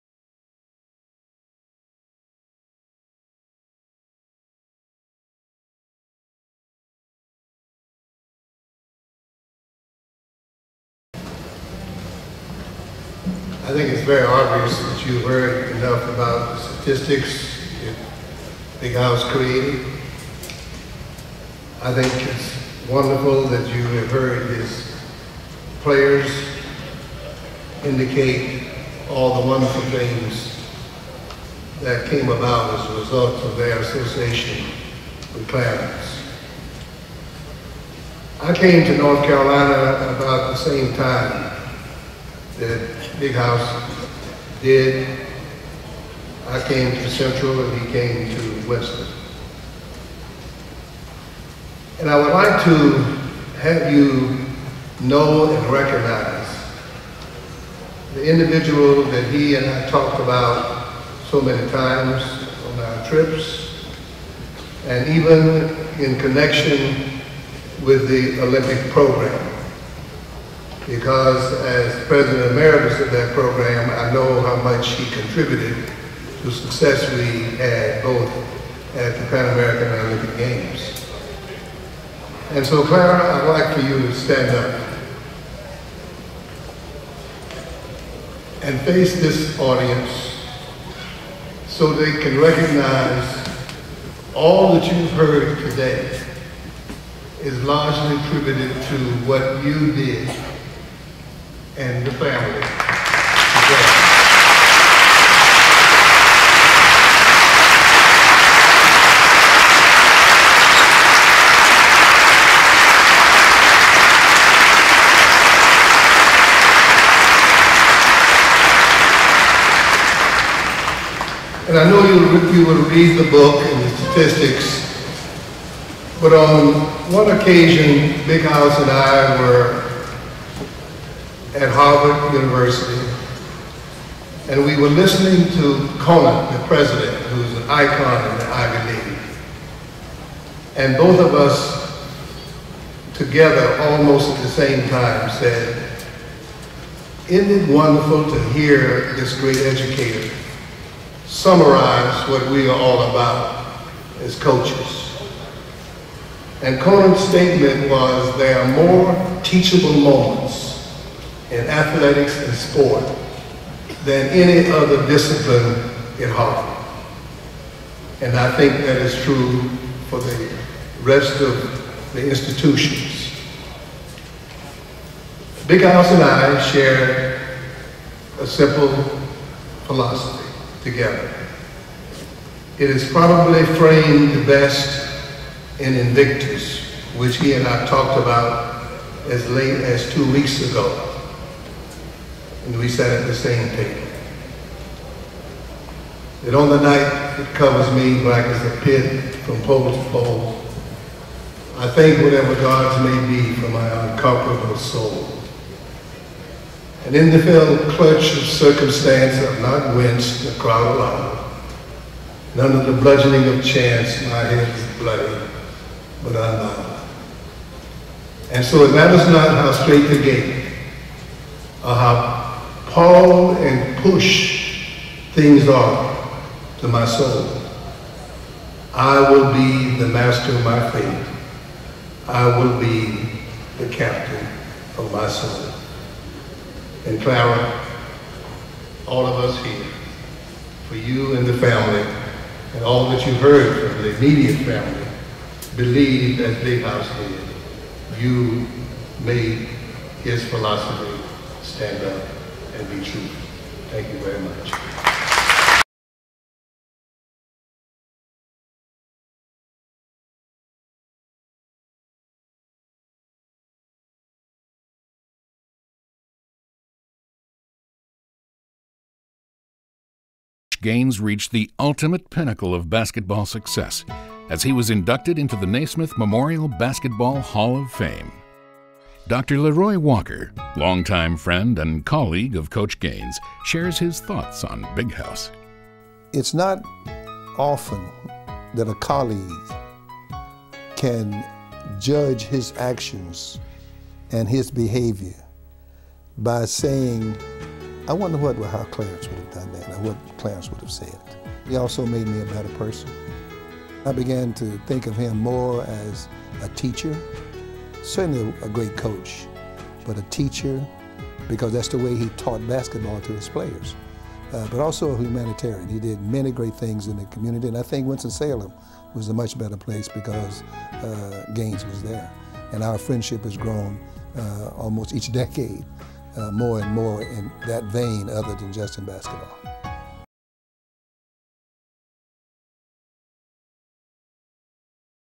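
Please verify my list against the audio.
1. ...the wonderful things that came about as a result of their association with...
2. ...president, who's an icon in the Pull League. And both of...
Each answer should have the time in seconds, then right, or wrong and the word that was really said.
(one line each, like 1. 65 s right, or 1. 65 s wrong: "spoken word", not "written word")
1. 29 s right
2. 136 s wrong: "Ivy", not "Pull".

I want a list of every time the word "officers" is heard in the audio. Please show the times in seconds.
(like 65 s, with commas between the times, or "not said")
not said.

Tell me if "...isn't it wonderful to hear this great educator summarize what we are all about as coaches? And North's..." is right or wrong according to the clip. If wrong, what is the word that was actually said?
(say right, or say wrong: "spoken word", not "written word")
wrong: "Conant", not "North".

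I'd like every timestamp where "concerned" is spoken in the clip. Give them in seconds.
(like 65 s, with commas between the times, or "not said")
not said.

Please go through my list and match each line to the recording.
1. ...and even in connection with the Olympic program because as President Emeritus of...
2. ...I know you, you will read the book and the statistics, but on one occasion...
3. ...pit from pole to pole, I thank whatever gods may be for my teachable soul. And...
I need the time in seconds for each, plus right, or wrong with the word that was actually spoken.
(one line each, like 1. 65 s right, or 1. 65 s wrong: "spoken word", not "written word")
1. 64 s right
2. 121 s right
3. 198 s wrong: "unconquerable", not "teachable".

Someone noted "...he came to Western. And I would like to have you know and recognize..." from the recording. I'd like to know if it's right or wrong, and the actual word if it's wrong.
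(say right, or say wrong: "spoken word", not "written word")
right.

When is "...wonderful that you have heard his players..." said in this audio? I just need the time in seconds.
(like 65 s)
22 s.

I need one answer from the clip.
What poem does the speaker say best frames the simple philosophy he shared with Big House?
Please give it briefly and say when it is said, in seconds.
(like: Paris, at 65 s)
Invictus, at 185 s.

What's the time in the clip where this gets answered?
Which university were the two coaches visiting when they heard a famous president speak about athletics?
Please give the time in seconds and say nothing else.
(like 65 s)
131 s.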